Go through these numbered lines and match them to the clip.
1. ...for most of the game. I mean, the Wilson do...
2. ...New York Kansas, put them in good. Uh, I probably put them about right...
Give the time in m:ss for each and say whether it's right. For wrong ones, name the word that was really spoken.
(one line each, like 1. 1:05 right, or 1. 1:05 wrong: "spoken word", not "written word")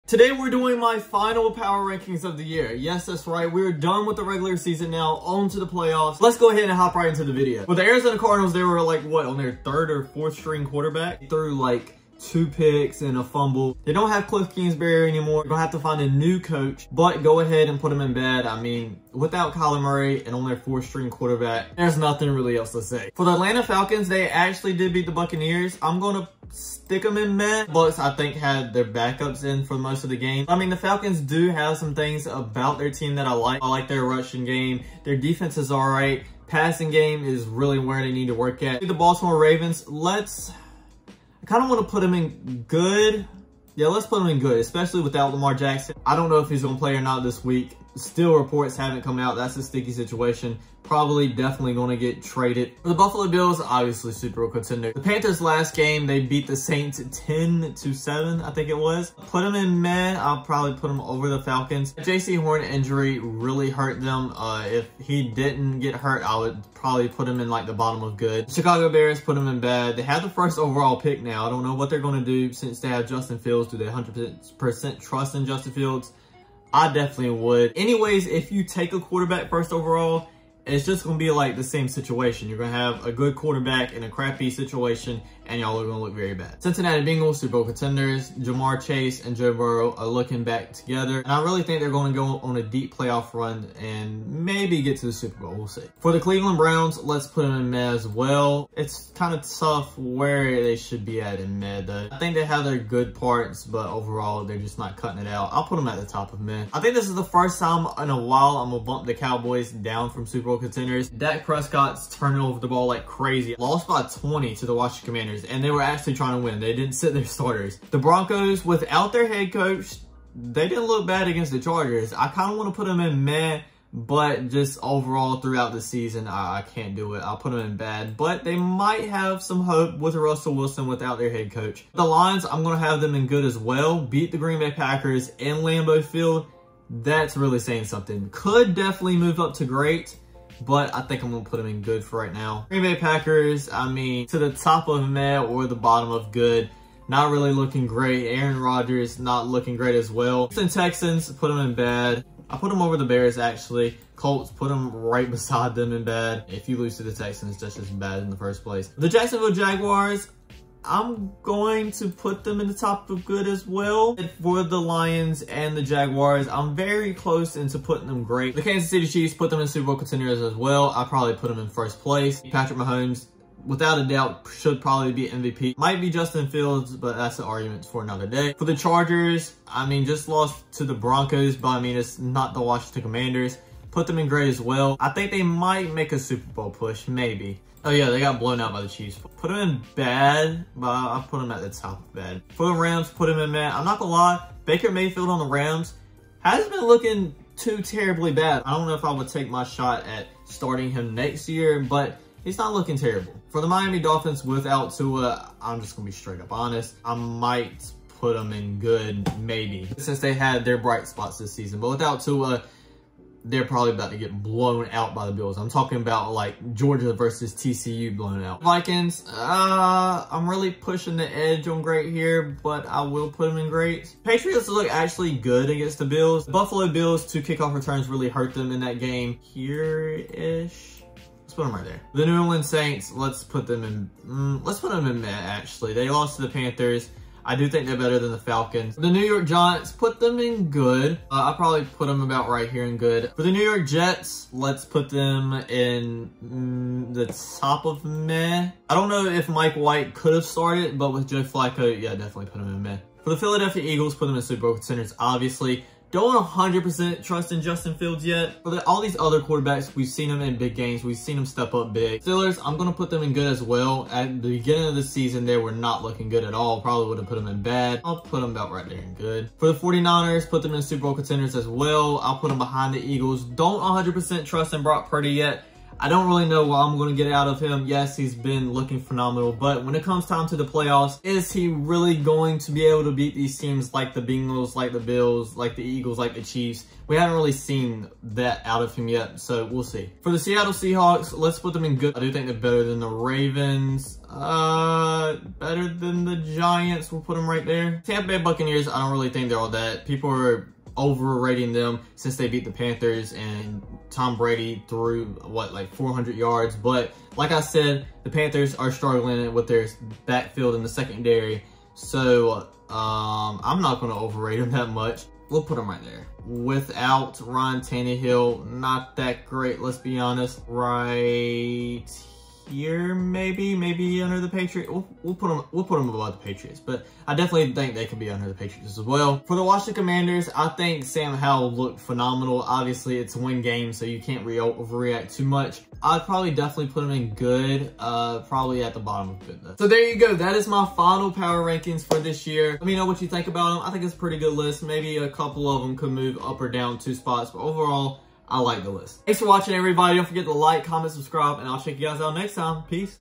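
1. 0:29 wrong: "Falcons", not "Wilson"
2. 3:59 wrong: "Giants", not "Kansas".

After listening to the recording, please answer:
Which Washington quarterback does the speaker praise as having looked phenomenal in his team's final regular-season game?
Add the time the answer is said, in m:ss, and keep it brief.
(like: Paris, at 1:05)
Sam Howell, at 5:31.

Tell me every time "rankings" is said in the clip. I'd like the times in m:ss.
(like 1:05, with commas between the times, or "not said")
0:01, 5:41.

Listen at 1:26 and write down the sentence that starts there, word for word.
Cincinnati Bengals, Super Bowl contenders, Ja'Marr Chase and Joe Burrow are looking back together.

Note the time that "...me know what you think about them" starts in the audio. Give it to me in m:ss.
5:42.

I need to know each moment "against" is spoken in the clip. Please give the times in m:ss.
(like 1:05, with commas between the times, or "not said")
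2:01, 3:45.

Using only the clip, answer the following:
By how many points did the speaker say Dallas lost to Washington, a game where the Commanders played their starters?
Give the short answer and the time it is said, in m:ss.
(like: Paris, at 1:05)
20, at 1:54.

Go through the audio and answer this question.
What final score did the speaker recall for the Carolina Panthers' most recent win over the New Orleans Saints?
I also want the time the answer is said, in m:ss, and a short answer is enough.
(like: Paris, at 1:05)
10 to 7, at 0:57.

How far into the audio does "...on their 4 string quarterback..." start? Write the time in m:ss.
0:20.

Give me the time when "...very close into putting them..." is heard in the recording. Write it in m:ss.
2:46.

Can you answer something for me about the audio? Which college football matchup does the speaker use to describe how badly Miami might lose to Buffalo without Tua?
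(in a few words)
Georgia versus TCU.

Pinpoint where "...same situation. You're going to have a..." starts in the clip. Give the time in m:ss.
1:21.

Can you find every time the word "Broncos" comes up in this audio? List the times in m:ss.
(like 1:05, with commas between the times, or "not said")
1:57, 3:00.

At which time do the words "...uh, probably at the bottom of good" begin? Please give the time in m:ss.
5:37.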